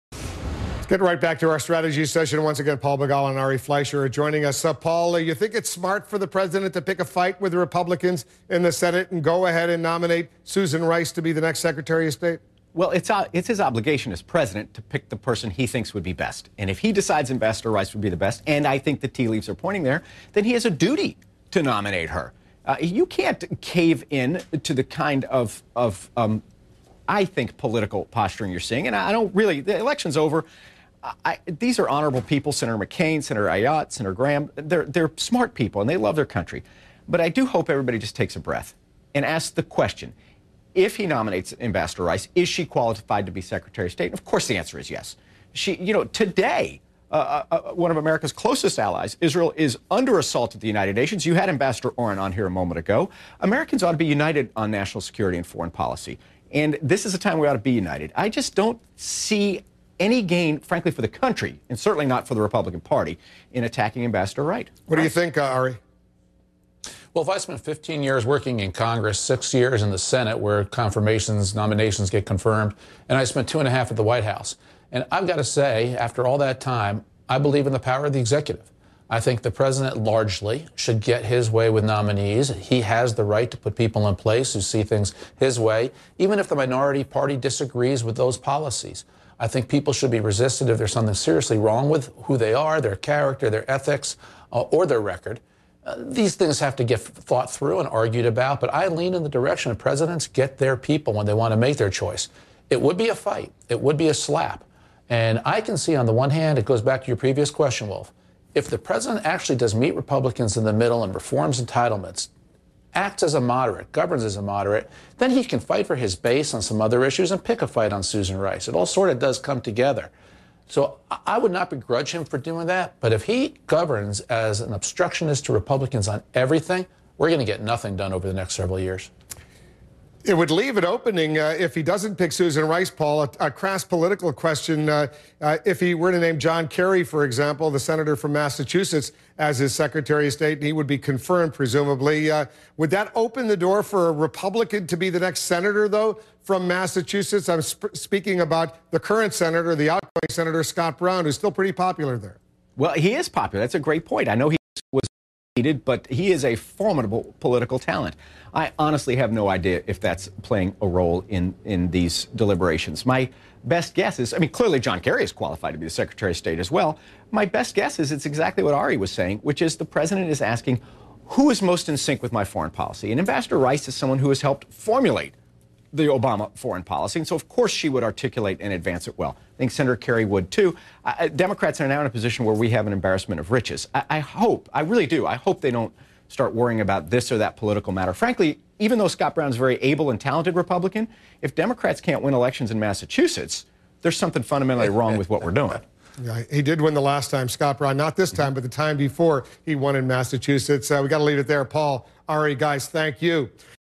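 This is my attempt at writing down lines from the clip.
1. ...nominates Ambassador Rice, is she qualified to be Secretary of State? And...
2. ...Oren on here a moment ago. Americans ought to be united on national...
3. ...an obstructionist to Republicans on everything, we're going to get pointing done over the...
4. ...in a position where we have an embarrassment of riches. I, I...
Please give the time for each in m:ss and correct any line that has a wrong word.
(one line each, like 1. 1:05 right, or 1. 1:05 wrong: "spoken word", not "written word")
1. 0:41 right
2. 0:51 right
3. 2:04 wrong: "nothing", not "pointing"
4. 3:02 right.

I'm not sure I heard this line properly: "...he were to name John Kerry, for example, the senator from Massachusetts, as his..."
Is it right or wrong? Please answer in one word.
right.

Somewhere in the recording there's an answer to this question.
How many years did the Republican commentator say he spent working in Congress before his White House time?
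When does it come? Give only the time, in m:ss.
1:07.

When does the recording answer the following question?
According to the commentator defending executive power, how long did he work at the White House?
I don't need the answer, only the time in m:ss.
1:13.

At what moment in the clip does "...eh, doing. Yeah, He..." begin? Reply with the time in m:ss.
3:15.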